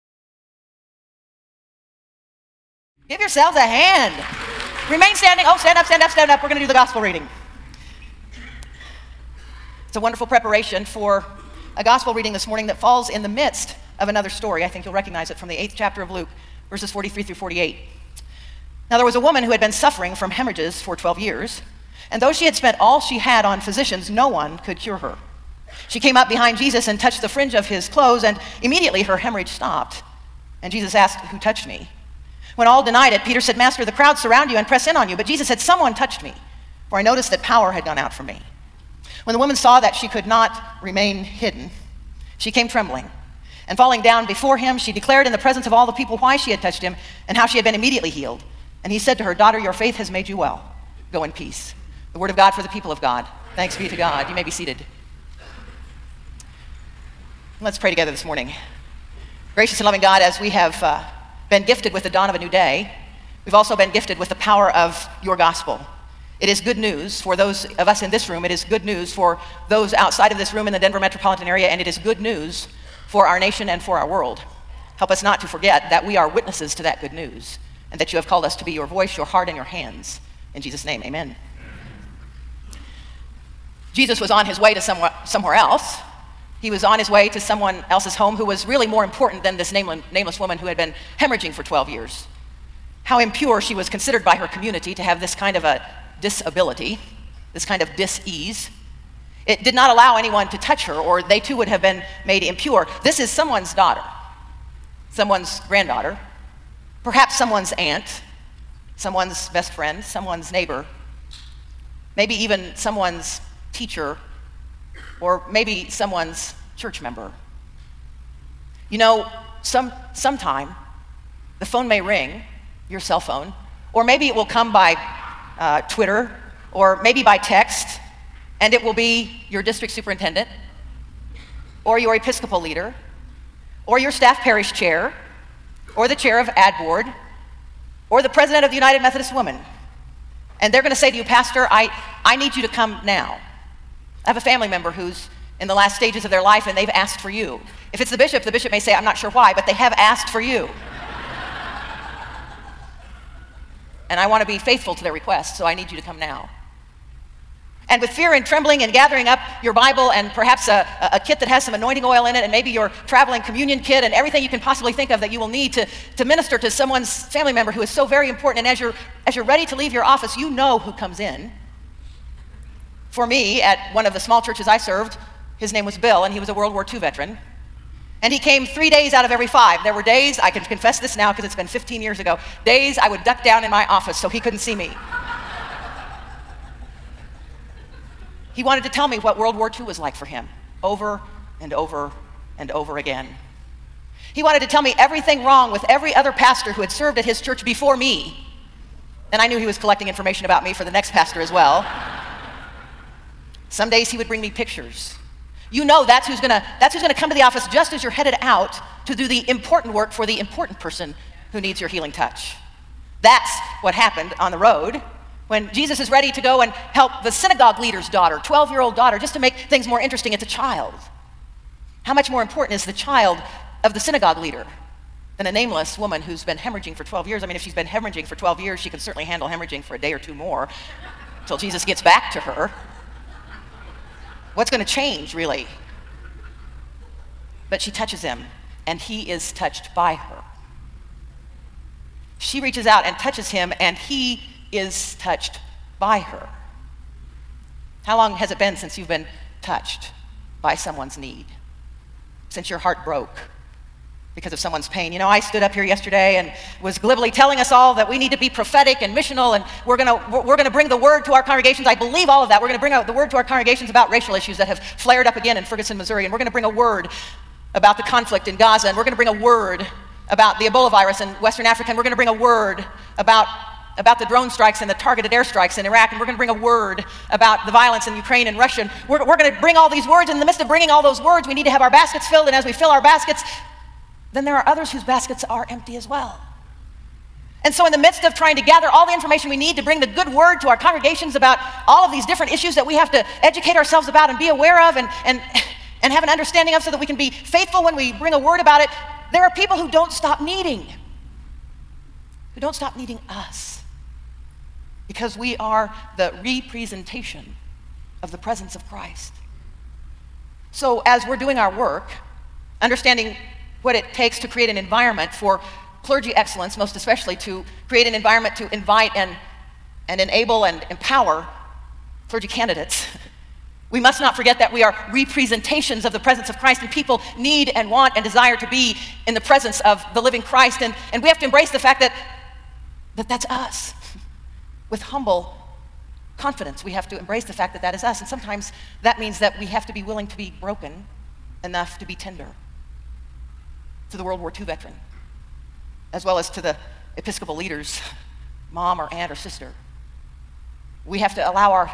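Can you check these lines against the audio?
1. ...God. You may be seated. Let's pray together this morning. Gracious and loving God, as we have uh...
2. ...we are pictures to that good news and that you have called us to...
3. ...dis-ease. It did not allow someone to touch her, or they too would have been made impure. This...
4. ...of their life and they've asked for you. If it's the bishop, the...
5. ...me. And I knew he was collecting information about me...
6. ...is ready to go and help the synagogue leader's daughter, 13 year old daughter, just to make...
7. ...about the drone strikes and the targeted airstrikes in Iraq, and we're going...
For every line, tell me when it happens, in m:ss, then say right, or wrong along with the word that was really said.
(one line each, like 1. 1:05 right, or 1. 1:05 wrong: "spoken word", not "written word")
1. 0:53 right
2. 1:16 wrong: "witnesses", not "pictures"
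3. 1:37 wrong: "anyone", not "someone"
4. 2:26 right
5. 3:17 right
6. 3:35 wrong: "12", not "13"
7. 4:33 right.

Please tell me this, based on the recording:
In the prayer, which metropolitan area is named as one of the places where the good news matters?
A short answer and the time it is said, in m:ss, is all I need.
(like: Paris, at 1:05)
Denver, at 1:10.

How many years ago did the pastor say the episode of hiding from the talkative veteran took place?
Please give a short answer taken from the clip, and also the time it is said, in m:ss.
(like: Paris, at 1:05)
15, at 3:01.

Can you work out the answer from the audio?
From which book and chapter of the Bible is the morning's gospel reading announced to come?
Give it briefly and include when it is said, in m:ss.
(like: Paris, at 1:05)
Luke 8, at 0:15.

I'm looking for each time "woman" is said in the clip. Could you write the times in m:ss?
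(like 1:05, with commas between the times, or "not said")
0:19, 0:39, 1:30, 3:45.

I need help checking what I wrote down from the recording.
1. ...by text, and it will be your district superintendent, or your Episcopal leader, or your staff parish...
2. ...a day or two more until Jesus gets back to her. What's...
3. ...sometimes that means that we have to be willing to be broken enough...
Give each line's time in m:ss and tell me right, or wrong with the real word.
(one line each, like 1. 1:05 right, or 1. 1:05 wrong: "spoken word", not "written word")
1. 2:07 right
2. 3:49 right
3. 5:38 right.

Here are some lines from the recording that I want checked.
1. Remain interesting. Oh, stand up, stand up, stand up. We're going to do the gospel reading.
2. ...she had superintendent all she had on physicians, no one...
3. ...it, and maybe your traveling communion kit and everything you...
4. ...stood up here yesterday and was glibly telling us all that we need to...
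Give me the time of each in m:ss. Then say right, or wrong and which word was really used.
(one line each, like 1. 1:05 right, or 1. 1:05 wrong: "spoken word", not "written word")
1. 0:04 wrong: "standing", not "interesting"
2. 0:22 wrong: "spent", not "superintendent"
3. 2:42 right
4. 4:15 right.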